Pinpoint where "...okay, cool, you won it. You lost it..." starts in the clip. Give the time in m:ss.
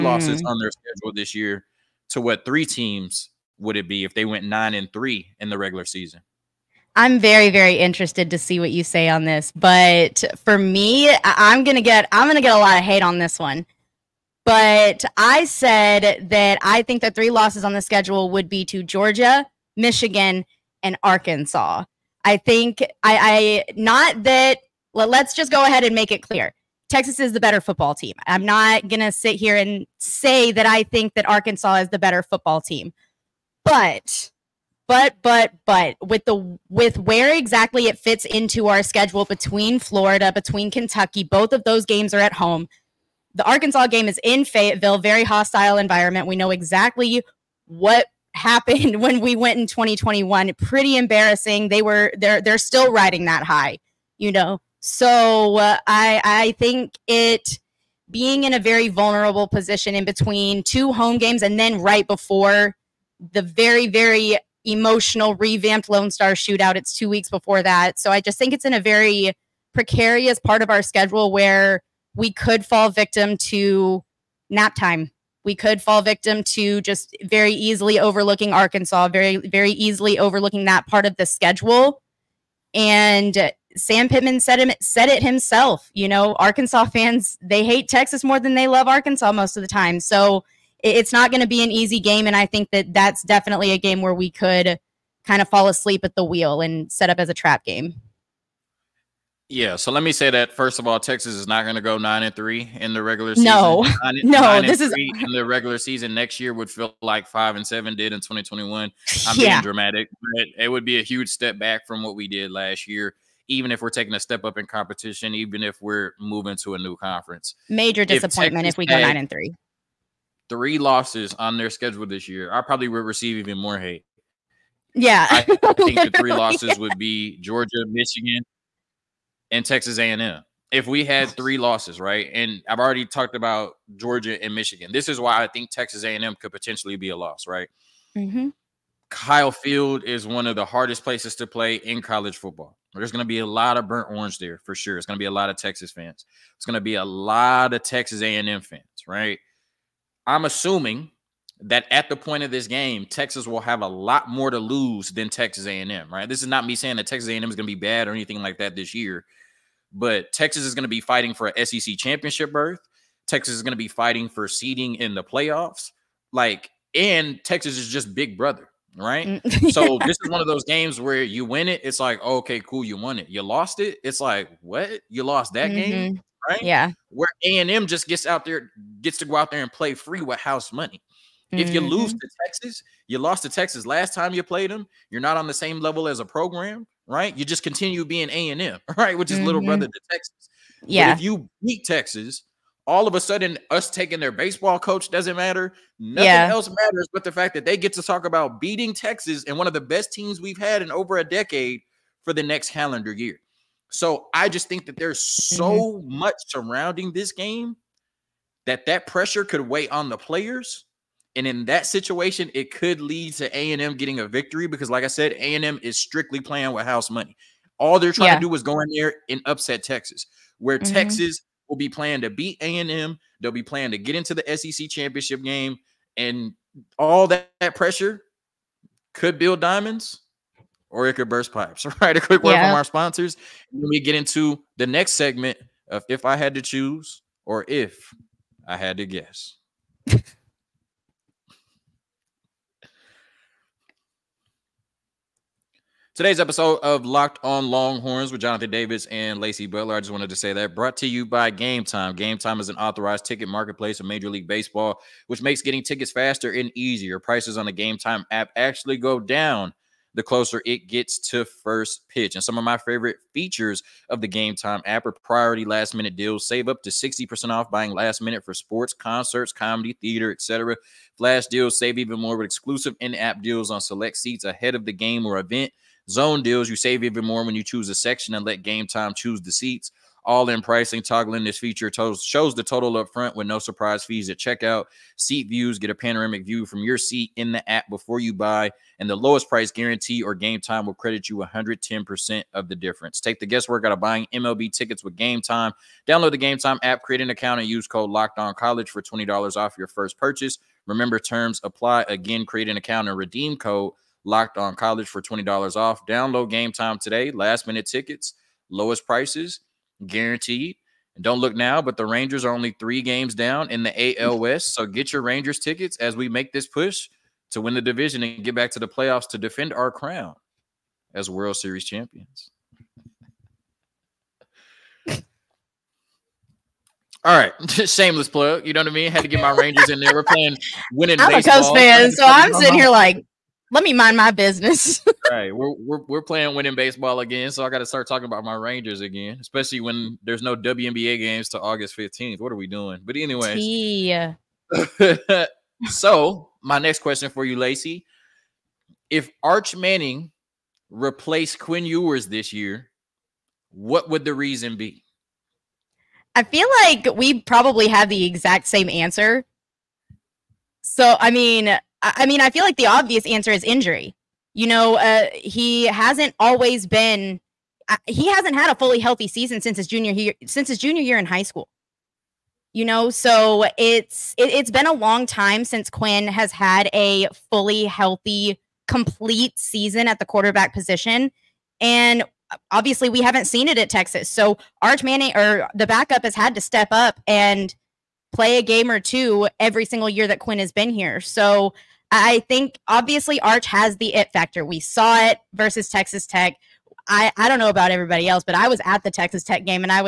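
2:52.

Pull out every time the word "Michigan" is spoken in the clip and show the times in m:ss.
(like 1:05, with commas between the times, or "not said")
0:19, 2:07, 2:14.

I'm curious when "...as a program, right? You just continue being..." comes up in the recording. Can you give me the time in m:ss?
3:06.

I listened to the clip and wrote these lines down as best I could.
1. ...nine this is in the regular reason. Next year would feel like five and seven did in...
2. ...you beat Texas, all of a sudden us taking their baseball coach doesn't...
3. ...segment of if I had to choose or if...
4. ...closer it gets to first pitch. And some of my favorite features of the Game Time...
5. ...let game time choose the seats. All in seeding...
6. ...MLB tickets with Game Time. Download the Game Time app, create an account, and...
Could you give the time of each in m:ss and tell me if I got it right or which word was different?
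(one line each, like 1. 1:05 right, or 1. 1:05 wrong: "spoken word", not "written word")
1. 1:44 wrong: "season", not "reason"
2. 3:11 right
3. 3:55 right
4. 4:20 right
5. 4:38 wrong: "pricing", not "seeding"
6. 4:54 right.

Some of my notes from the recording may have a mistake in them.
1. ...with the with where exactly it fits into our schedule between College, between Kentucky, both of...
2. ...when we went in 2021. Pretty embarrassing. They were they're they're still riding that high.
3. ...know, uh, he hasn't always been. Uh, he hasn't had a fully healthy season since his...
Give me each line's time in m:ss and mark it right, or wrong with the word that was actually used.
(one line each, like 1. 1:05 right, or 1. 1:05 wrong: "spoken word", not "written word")
1. 0:36 wrong: "Florida", not "College"
2. 0:48 right
3. 6:04 right.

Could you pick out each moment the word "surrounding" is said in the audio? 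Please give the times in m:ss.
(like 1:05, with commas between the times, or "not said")
3:26.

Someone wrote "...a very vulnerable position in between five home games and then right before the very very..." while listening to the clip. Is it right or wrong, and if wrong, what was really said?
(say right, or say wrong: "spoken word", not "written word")
wrong: "two", not "five".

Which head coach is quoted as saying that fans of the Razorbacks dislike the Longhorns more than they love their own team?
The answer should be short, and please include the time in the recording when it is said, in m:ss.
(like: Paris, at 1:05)
Sam Pittman, at 1:23.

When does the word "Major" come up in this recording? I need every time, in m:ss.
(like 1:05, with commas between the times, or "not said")
1:57, 4:14.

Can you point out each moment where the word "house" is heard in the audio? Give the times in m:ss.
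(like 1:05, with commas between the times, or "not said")
3:00, 3:36.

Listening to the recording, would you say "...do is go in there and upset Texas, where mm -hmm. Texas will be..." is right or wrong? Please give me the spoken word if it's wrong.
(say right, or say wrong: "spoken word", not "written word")
right.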